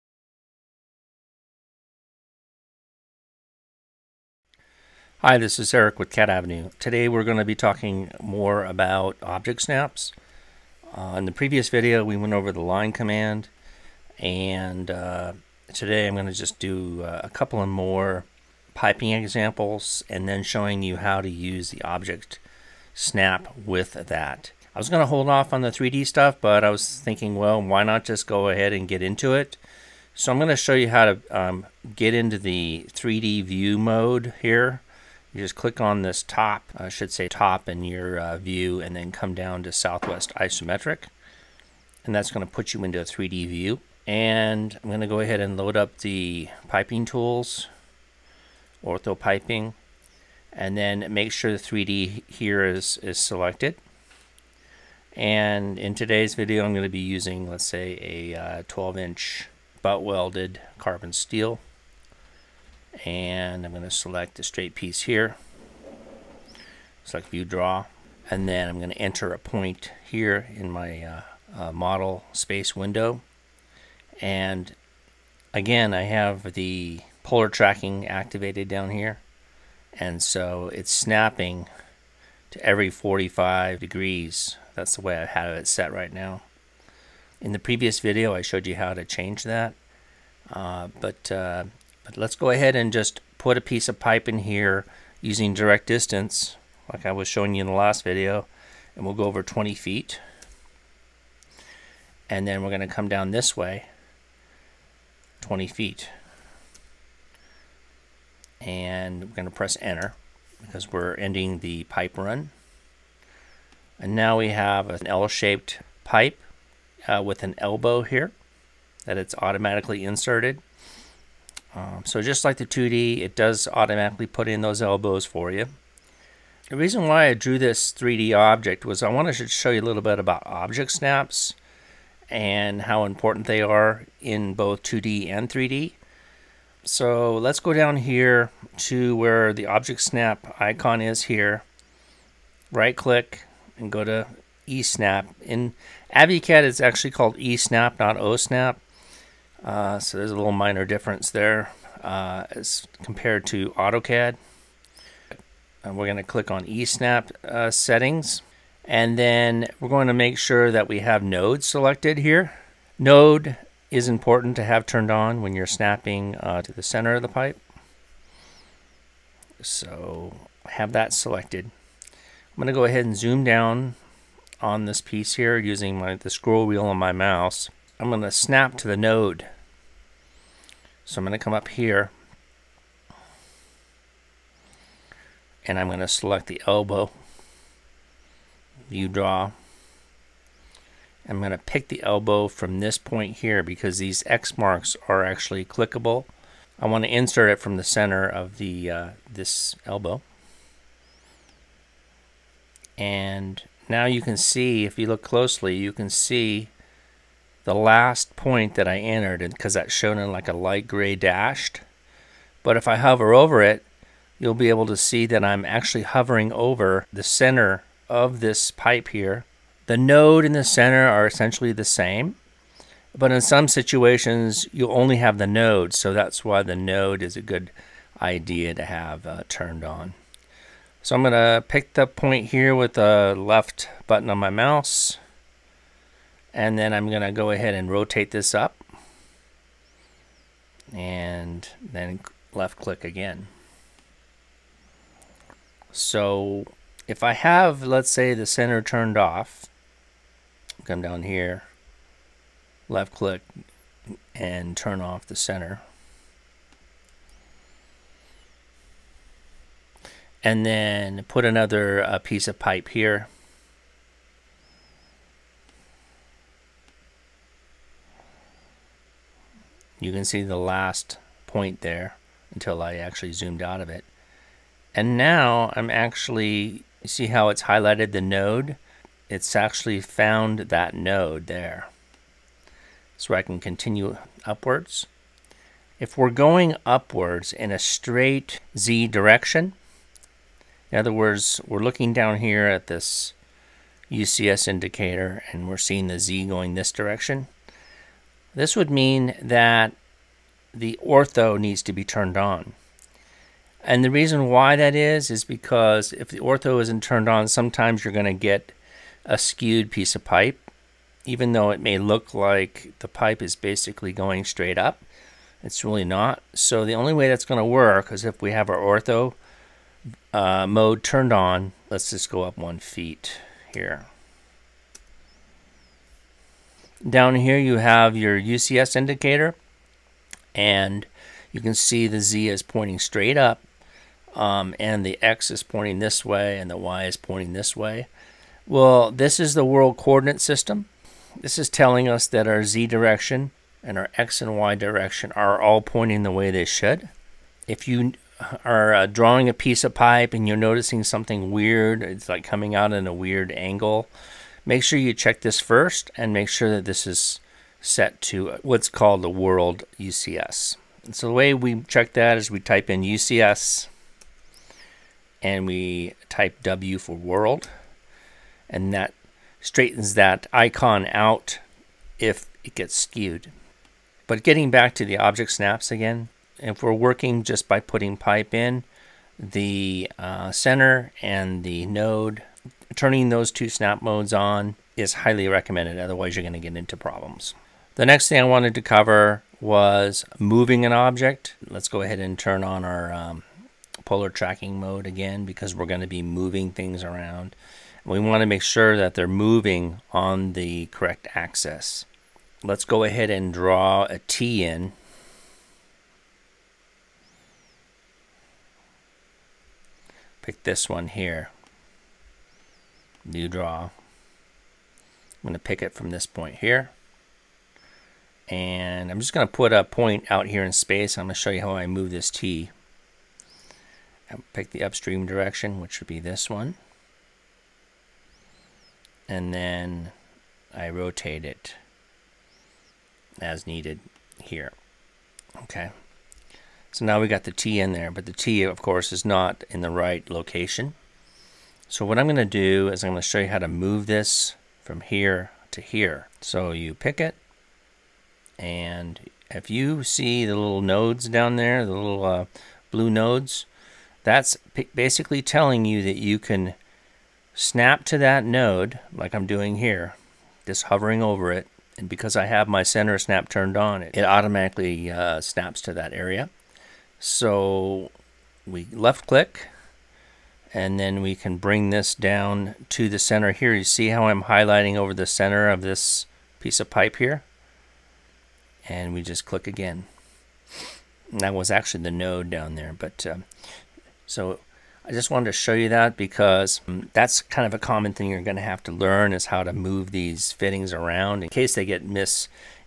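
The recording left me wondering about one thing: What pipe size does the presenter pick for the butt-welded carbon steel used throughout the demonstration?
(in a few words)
12-inch.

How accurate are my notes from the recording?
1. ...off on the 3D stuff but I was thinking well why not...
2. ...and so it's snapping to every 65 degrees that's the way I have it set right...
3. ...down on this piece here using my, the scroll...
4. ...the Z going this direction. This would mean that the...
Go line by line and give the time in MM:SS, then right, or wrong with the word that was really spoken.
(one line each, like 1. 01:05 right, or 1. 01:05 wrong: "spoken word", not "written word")
1. 00:25 right
2. 01:19 wrong: "45", not "65"
3. 02:53 right
4. 04:56 right.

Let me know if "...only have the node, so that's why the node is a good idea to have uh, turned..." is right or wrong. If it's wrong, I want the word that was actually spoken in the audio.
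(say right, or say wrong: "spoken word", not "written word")
right.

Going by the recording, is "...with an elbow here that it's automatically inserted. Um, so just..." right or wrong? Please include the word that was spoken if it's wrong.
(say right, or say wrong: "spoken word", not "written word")
right.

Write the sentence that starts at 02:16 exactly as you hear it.
So let's go down here to where the object snap icon is here.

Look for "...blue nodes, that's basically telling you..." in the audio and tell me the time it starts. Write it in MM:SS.
07:32.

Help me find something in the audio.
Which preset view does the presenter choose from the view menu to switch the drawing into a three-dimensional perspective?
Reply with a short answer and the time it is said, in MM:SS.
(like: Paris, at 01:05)
Southwest Isometric, at 00:39.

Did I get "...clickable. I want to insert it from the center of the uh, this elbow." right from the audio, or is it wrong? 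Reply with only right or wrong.
right.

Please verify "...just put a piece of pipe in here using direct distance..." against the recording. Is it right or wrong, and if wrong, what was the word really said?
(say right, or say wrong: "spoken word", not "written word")
right.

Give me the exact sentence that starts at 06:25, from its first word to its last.
Otherwise, you're going to get into problems.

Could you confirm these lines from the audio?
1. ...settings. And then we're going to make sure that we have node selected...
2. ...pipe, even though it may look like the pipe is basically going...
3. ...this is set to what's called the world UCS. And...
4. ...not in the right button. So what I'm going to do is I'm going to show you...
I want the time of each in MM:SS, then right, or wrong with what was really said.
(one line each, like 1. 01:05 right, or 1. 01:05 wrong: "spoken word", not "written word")
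1. 02:37 right
2. 05:10 right
3. 05:56 right
4. 07:19 wrong: "location", not "button".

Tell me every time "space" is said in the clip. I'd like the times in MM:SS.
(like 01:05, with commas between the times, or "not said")
01:12, 07:00.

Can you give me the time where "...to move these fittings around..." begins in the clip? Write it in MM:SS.
08:09.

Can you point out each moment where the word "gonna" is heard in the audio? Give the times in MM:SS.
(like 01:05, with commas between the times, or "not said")
01:42, 01:49.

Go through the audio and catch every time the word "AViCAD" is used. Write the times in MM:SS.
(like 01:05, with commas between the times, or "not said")
02:26.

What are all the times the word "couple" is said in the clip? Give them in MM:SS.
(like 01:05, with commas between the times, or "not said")
00:17.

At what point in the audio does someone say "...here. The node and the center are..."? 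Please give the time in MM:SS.
03:39.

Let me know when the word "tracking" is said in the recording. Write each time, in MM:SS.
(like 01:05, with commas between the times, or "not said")
01:17, 06:34.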